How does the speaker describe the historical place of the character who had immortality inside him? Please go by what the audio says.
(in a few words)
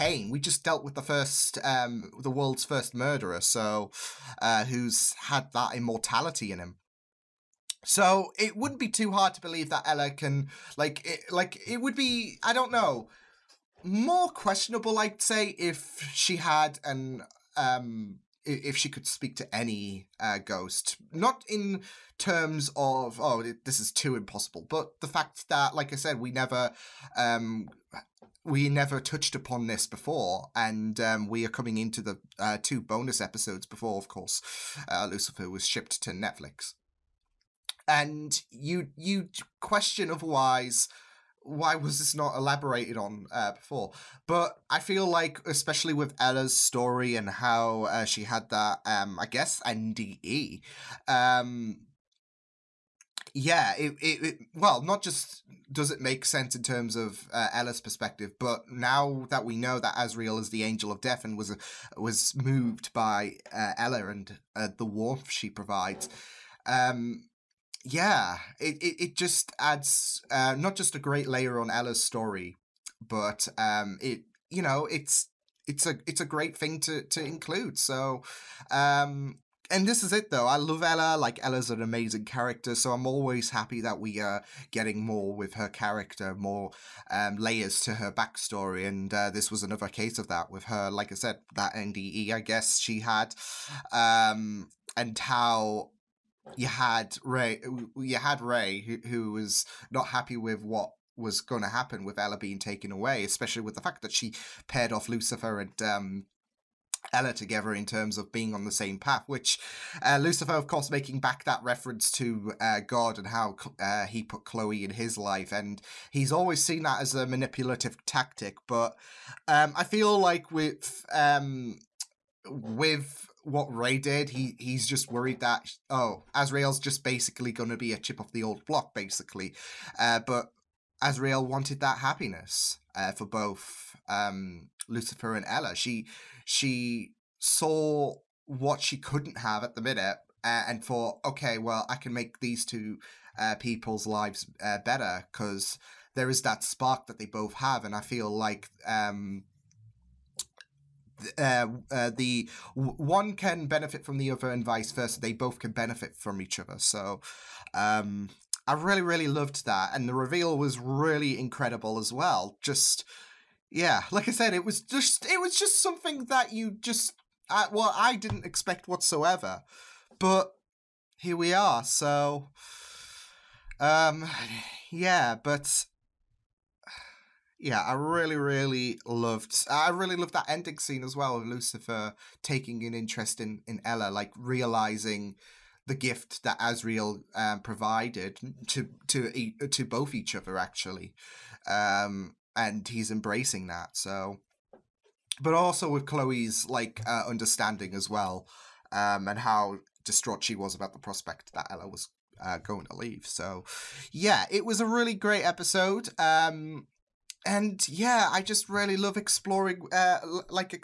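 The world's first murderer.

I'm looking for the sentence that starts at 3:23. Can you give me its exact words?
So, yeah, it was a really great episode.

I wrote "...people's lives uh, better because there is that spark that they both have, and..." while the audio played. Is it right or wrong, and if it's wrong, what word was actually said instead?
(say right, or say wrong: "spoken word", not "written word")
right.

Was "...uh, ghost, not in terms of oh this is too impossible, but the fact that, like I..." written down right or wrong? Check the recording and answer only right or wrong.
right.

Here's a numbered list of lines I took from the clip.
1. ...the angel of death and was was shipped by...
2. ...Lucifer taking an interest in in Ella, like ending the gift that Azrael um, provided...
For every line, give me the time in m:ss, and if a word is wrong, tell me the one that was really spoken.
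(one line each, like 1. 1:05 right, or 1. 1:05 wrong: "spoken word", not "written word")
1. 1:00 wrong: "moved", not "shipped"
2. 3:01 wrong: "realizing", not "ending".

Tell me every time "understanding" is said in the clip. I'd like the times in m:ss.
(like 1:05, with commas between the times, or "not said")
3:17.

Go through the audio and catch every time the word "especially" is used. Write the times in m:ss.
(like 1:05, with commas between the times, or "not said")
0:45, 1:43.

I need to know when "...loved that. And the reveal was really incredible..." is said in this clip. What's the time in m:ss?
2:39.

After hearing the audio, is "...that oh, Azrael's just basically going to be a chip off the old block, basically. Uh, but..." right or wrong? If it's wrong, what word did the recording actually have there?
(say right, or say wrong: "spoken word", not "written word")
right.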